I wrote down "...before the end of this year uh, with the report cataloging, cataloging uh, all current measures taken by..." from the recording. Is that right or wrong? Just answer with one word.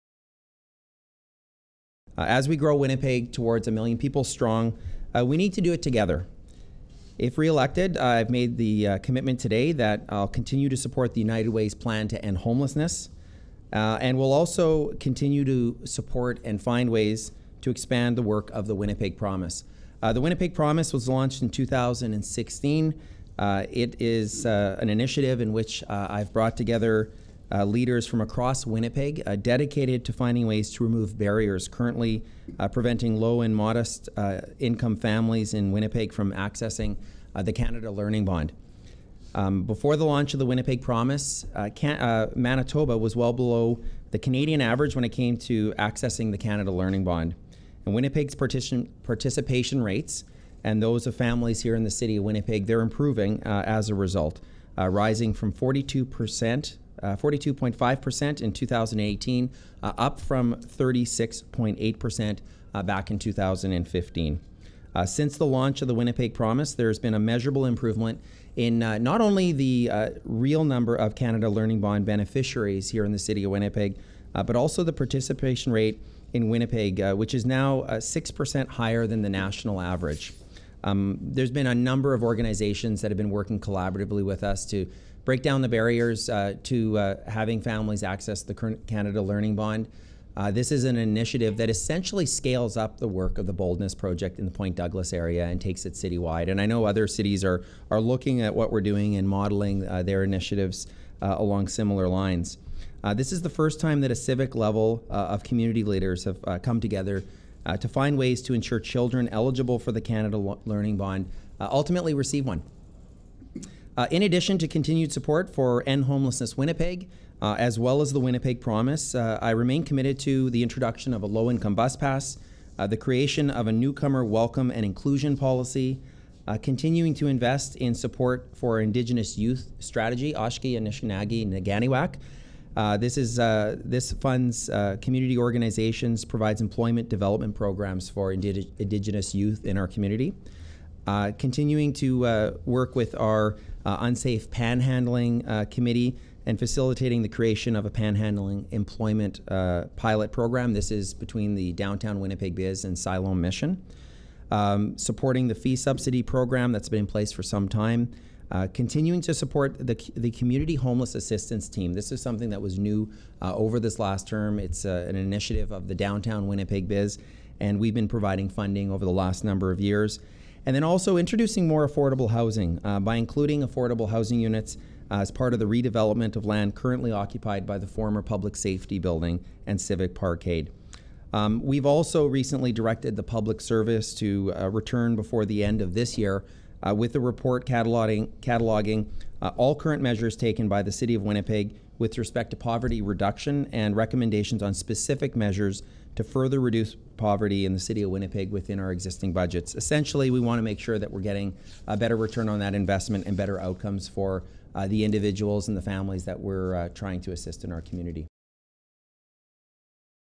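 right.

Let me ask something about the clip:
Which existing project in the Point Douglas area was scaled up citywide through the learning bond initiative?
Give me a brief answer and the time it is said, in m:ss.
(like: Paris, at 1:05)
the Boldness Project, at 1:33.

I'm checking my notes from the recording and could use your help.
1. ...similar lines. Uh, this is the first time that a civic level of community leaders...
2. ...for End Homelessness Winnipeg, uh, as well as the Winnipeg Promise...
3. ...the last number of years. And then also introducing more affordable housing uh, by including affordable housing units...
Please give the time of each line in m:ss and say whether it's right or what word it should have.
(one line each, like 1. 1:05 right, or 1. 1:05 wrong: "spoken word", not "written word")
1. 1:41 right
2. 1:55 right
3. 2:49 right.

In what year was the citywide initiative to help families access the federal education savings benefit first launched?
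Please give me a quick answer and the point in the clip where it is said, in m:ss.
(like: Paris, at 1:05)
2016, at 0:21.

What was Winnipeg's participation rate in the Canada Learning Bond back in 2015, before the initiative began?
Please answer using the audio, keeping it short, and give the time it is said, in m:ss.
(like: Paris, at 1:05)
36.8%, at 1:00.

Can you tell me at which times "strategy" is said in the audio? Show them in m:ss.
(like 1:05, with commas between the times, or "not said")
2:09.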